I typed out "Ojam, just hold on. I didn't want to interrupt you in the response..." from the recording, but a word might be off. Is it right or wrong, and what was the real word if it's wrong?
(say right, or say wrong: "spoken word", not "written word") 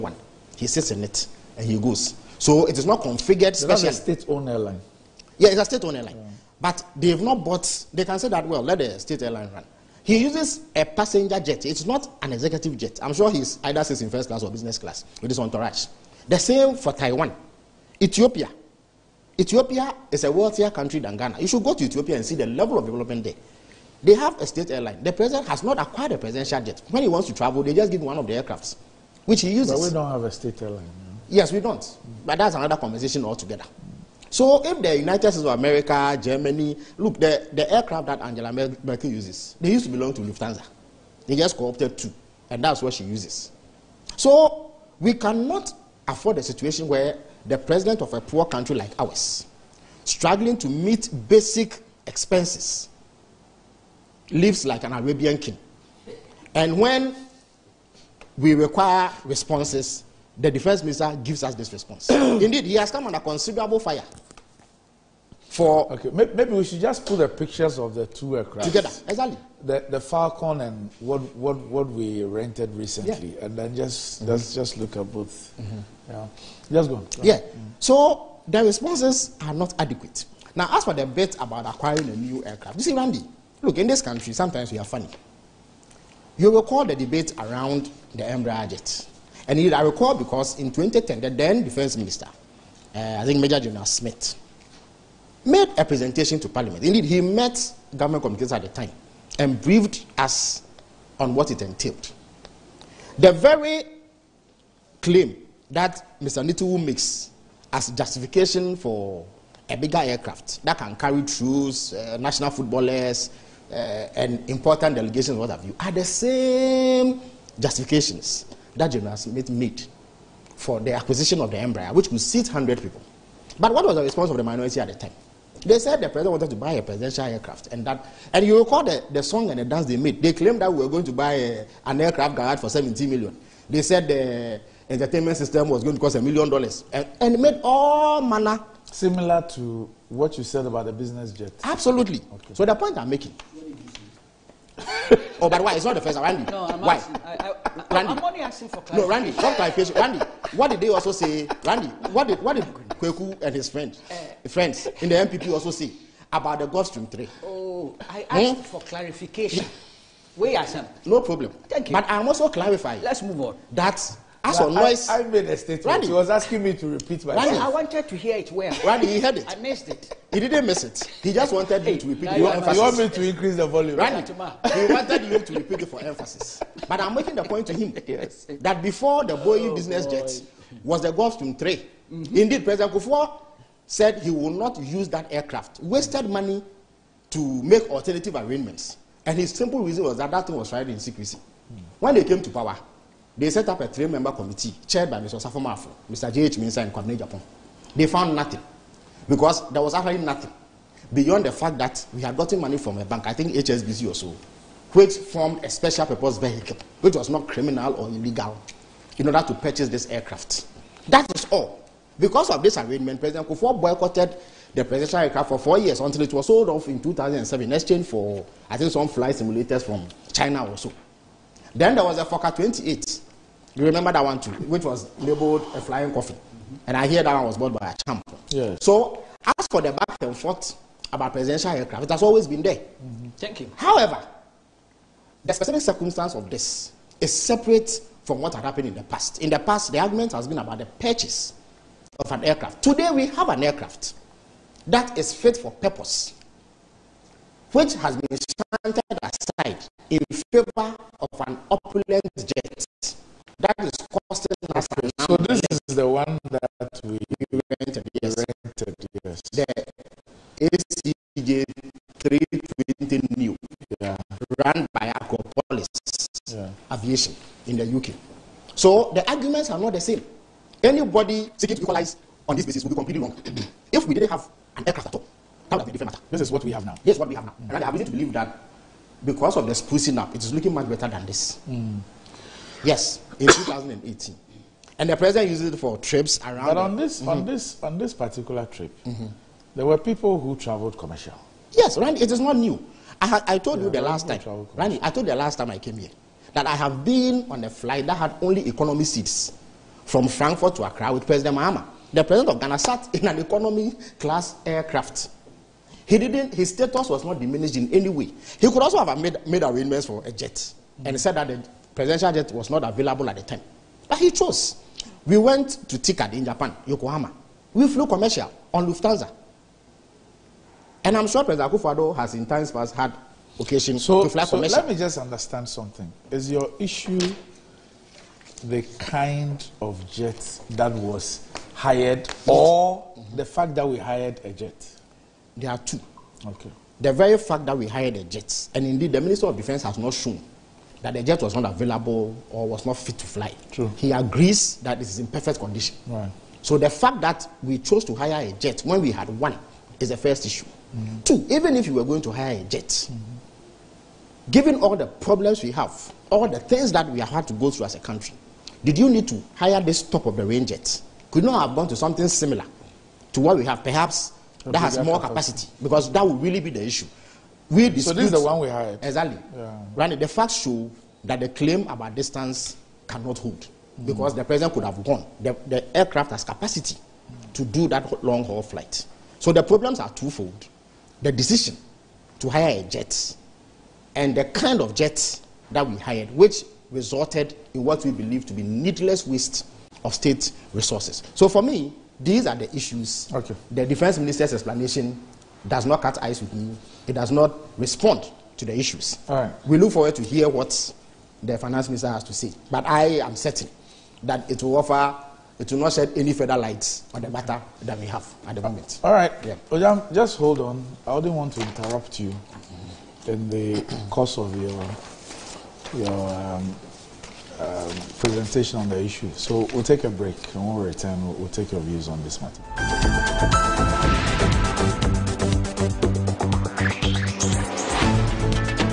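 wrong: "course", not "response".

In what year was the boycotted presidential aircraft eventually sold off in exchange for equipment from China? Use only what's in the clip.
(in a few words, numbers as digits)
2007.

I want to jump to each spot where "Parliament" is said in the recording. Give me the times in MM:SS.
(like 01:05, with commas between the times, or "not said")
01:36.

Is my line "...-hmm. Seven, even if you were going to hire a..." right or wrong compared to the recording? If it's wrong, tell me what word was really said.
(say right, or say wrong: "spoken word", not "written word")
wrong: "Two", not "Seven".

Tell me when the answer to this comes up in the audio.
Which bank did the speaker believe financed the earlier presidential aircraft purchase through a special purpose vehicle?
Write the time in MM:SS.
03:23.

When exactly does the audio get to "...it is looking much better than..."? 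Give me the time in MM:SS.
04:40.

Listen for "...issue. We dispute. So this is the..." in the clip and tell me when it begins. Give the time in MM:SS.
06:06.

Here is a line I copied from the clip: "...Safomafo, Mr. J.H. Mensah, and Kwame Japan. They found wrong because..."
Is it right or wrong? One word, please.
wrong.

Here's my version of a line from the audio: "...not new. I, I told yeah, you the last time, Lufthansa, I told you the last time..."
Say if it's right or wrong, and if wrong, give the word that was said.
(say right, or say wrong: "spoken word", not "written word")
wrong: "Randy", not "Lufthansa".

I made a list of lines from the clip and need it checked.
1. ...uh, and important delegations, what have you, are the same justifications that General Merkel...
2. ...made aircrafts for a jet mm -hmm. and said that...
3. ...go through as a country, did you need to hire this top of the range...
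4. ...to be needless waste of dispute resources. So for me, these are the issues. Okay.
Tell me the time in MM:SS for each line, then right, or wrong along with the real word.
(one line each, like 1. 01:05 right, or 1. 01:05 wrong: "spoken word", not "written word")
1. 01:53 wrong: "Smith", not "Merkel"
2. 05:09 wrong: "arrangements", not "aircrafts"
3. 05:57 right
4. 06:28 wrong: "state", not "dispute".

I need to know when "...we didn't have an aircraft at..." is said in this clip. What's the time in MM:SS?
04:34.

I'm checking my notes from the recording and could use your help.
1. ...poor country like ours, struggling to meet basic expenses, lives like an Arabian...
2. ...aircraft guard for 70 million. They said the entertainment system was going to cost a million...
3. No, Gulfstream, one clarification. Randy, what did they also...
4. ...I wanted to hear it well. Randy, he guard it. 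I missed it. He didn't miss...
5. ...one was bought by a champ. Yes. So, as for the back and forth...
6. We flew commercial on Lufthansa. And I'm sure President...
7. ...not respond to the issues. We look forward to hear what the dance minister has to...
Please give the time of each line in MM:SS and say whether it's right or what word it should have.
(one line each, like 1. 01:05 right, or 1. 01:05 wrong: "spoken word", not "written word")
1. 00:48 right
2. 02:11 right
3. 02:29 wrong: "Randy", not "Gulfstream"
4. 02:47 wrong: "heard", not "guard"
5. 03:47 right
6. 05:17 right
7. 06:37 wrong: "finance", not "dance".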